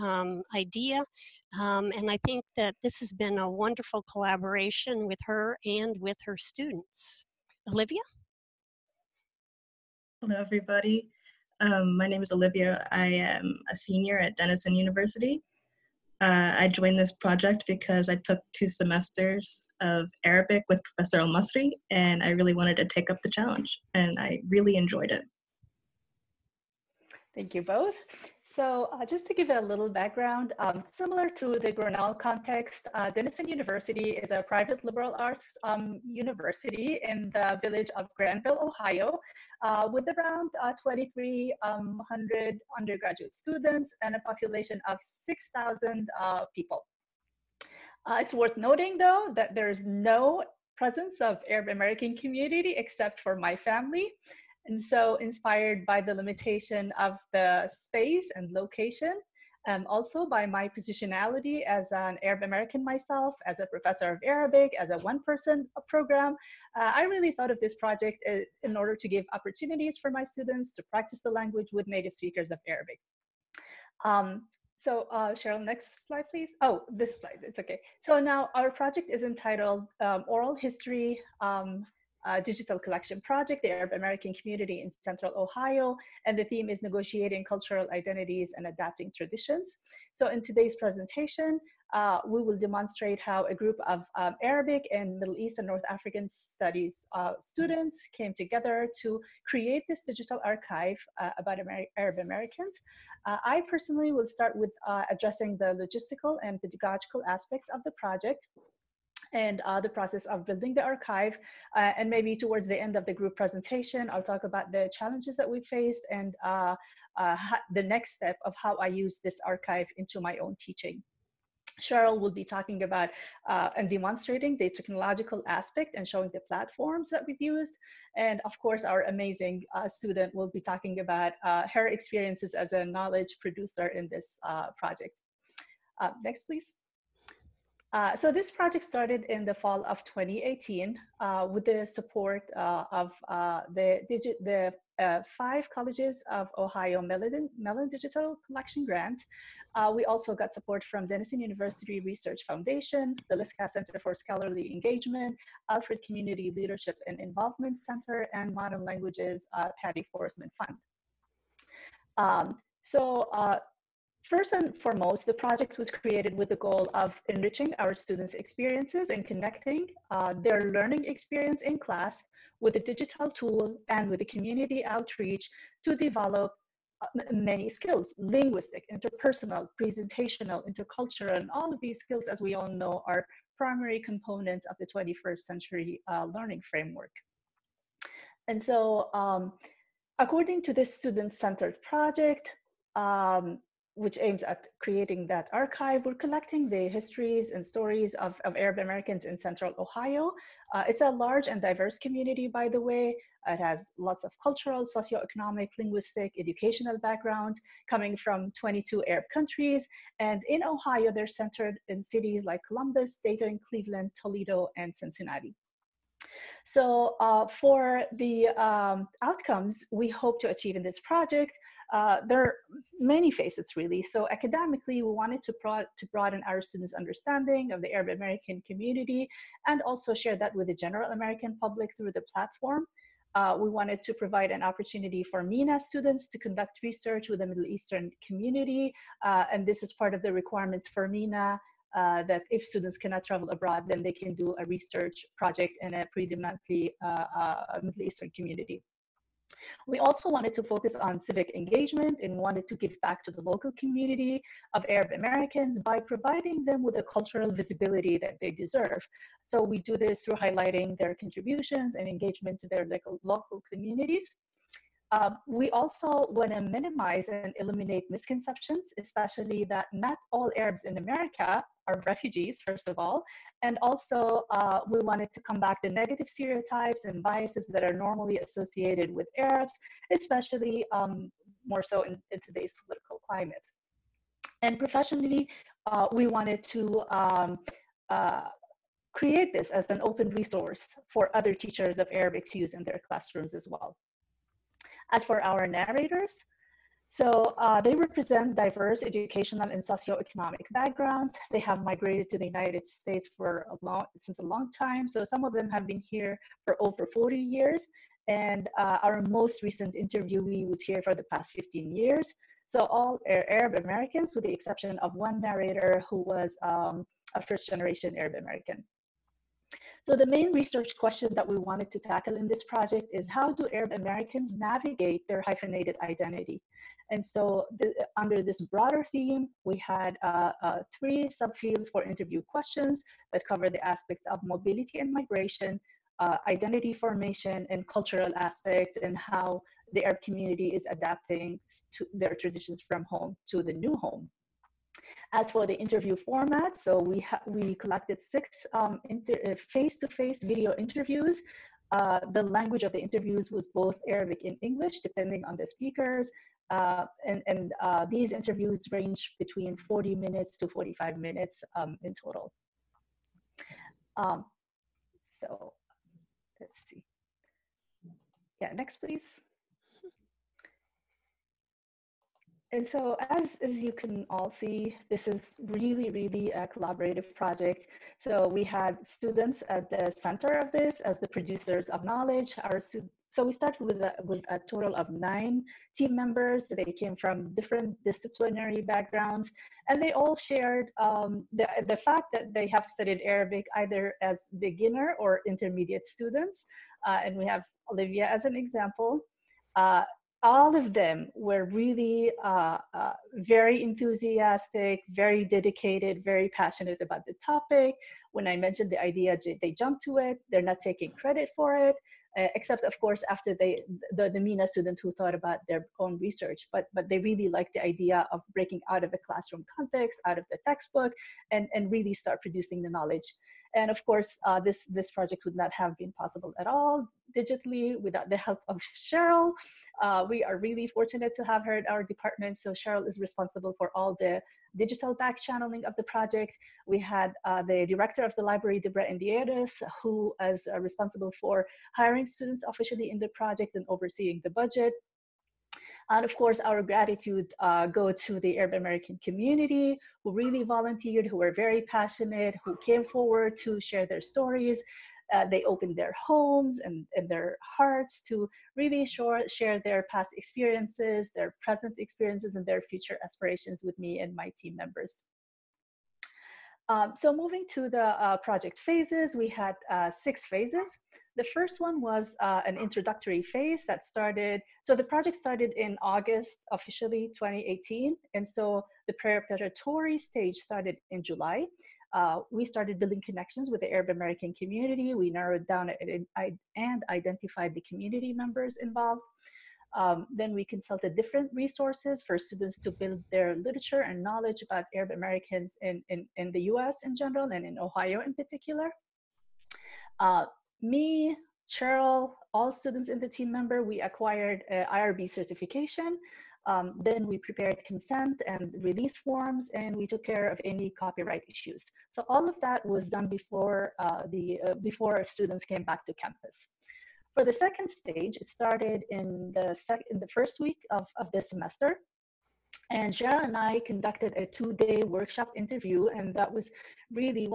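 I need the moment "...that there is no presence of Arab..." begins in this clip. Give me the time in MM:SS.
00:49.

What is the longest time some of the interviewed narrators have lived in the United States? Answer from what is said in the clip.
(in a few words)
over 40 years.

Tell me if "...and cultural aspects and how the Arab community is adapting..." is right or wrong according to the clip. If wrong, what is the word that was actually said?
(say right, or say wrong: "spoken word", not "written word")
right.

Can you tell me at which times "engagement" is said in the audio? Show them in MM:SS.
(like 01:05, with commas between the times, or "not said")
02:34, 04:11, 04:22.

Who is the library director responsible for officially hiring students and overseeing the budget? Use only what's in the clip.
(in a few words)
Debra Andreadis.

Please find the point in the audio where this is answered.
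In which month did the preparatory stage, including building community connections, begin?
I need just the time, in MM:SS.
08:01.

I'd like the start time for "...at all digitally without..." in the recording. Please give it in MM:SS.
07:06.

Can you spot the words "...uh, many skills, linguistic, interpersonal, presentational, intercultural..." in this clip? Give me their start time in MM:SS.
02:57.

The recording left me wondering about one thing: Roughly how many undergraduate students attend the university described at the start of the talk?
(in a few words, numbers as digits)
2,300.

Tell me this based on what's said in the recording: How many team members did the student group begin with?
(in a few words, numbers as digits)
9.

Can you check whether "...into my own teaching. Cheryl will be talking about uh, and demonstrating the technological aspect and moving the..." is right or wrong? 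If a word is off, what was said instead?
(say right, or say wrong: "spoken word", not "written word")
wrong: "showing", not "moving".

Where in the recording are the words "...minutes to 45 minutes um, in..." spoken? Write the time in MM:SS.
06:00.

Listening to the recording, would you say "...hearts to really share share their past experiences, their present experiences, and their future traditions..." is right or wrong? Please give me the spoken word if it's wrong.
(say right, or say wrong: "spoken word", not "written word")
wrong: "aspirations", not "traditions".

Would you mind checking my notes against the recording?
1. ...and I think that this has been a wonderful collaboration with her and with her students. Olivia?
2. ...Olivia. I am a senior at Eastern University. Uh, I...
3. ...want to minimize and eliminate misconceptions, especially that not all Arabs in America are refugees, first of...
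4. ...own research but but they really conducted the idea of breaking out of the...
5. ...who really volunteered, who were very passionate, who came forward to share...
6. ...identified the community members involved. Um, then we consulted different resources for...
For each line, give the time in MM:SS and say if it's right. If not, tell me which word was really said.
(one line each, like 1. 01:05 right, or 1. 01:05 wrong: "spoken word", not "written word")
1. 00:01 right
2. 00:12 wrong: "Denison", not "Eastern"
3. 04:26 right
4. 06:55 wrong: "liked", not "conducted"
5. 07:30 right
6. 08:07 right.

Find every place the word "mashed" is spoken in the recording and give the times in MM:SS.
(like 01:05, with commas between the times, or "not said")
not said.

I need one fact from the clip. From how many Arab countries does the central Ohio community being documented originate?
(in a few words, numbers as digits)
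22.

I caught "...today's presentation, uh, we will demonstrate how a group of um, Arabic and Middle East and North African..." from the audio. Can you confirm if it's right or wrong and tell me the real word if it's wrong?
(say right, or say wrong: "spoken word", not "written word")
right.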